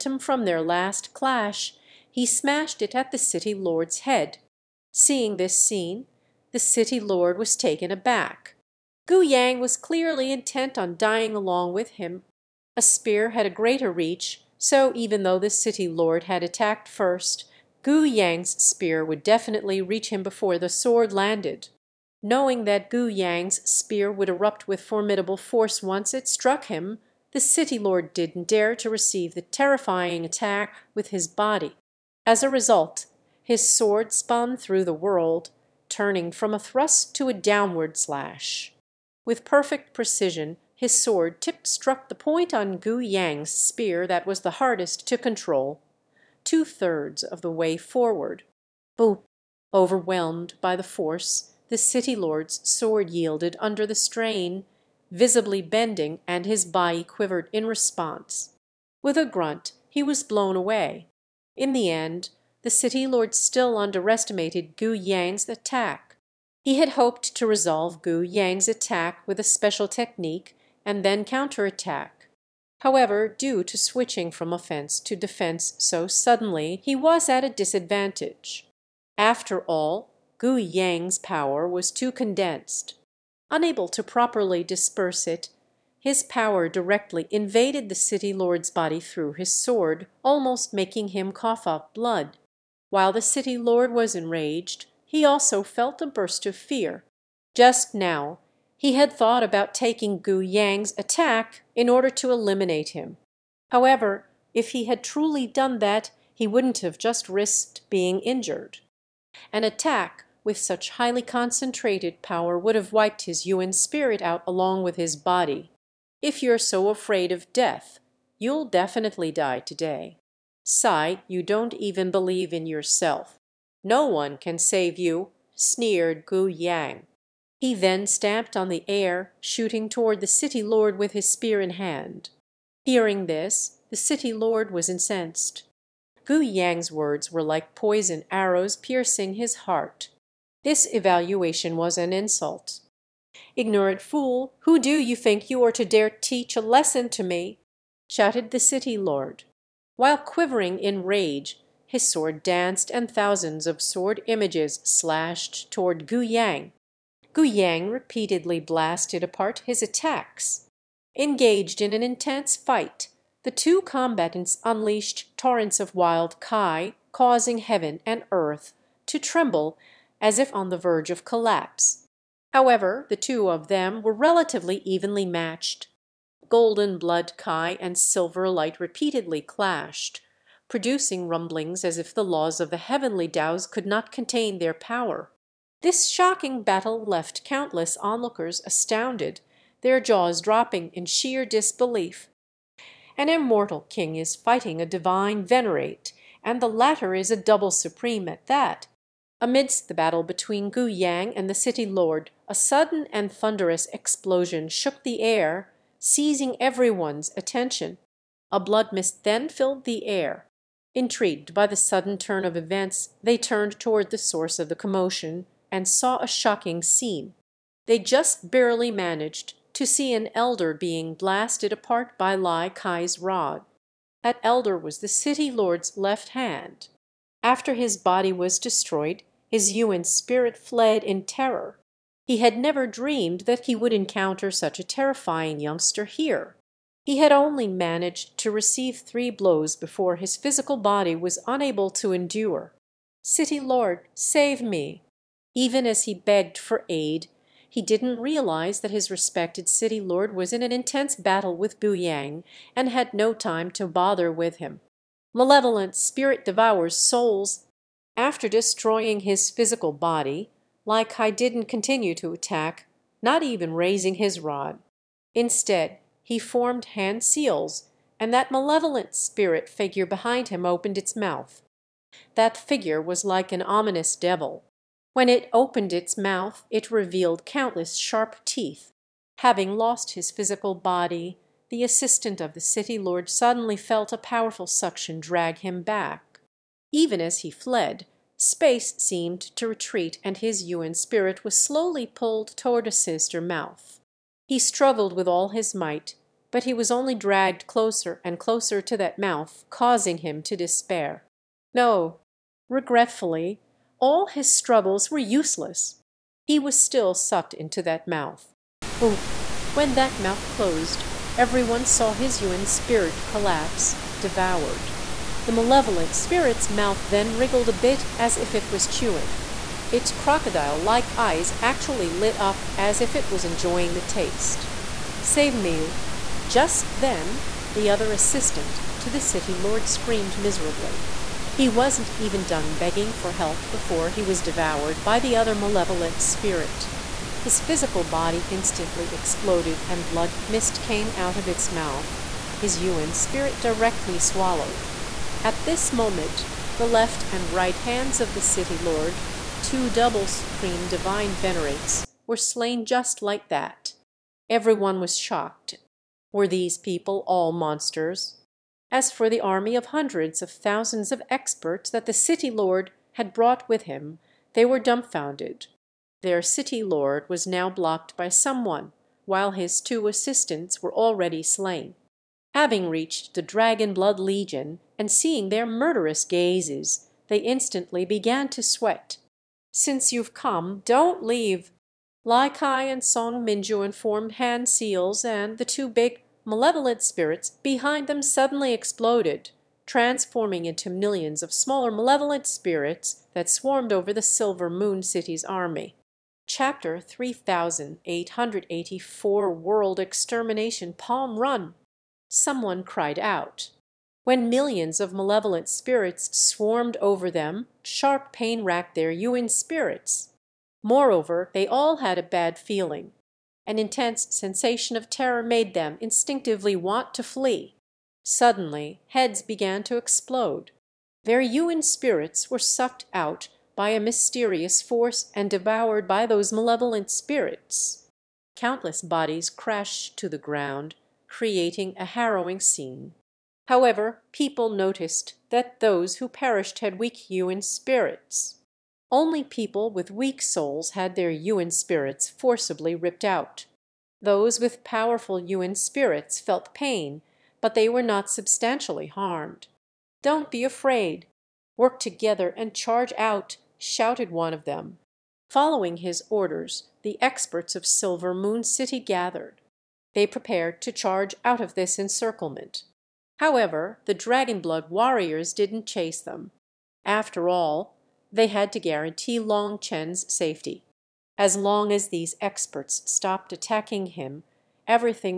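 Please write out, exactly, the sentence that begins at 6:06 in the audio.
Their City Lord was now blocked by someone, while his two assistants were already slain.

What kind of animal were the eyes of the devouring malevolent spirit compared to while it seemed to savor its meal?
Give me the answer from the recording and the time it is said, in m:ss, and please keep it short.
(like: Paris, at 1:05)
Crocodile, at 5:20.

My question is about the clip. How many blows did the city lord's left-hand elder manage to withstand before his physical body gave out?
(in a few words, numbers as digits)
3.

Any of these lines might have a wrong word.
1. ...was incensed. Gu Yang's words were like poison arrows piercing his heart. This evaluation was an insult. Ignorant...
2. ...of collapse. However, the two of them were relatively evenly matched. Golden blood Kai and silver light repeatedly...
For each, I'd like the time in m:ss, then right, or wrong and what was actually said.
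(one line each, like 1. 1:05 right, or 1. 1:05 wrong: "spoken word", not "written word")
1. 2:14 right
2. 2:51 right.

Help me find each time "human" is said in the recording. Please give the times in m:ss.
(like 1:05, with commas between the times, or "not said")
5:12, 6:49, 7:01, 7:17.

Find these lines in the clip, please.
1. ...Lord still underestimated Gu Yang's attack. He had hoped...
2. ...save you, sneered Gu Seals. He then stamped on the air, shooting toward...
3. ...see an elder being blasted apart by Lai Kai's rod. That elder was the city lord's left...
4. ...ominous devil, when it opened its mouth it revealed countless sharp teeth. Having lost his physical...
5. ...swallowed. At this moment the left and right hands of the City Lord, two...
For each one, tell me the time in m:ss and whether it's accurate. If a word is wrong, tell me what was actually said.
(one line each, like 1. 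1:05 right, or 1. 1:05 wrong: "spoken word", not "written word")
1. 1:03 right
2. 2:04 wrong: "Yang", not "Seals"
3. 3:39 right
4. 4:33 right
5. 5:44 right.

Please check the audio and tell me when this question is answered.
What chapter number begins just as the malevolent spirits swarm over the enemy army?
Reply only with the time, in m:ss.
6:36.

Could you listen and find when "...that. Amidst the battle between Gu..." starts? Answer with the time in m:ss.
3:18.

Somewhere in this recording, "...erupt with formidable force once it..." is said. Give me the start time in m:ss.
0:24.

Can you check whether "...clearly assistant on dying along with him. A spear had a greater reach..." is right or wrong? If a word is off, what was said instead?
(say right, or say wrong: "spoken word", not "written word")
wrong: "intent", not "assistant".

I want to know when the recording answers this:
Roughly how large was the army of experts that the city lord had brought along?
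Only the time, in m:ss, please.
5:59.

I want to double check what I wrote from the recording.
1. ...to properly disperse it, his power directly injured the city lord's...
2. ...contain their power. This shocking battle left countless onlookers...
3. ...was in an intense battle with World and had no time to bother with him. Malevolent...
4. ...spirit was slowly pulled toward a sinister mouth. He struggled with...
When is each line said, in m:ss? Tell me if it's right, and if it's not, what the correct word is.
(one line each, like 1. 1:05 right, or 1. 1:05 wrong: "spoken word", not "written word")
1. 1:23 wrong: "invaded", not "injured"
2. 3:04 right
3. 4:10 wrong: "Yang", not "World"
4. 4:50 right.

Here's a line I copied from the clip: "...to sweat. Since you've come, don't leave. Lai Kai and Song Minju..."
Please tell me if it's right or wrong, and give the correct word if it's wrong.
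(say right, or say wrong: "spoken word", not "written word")
right.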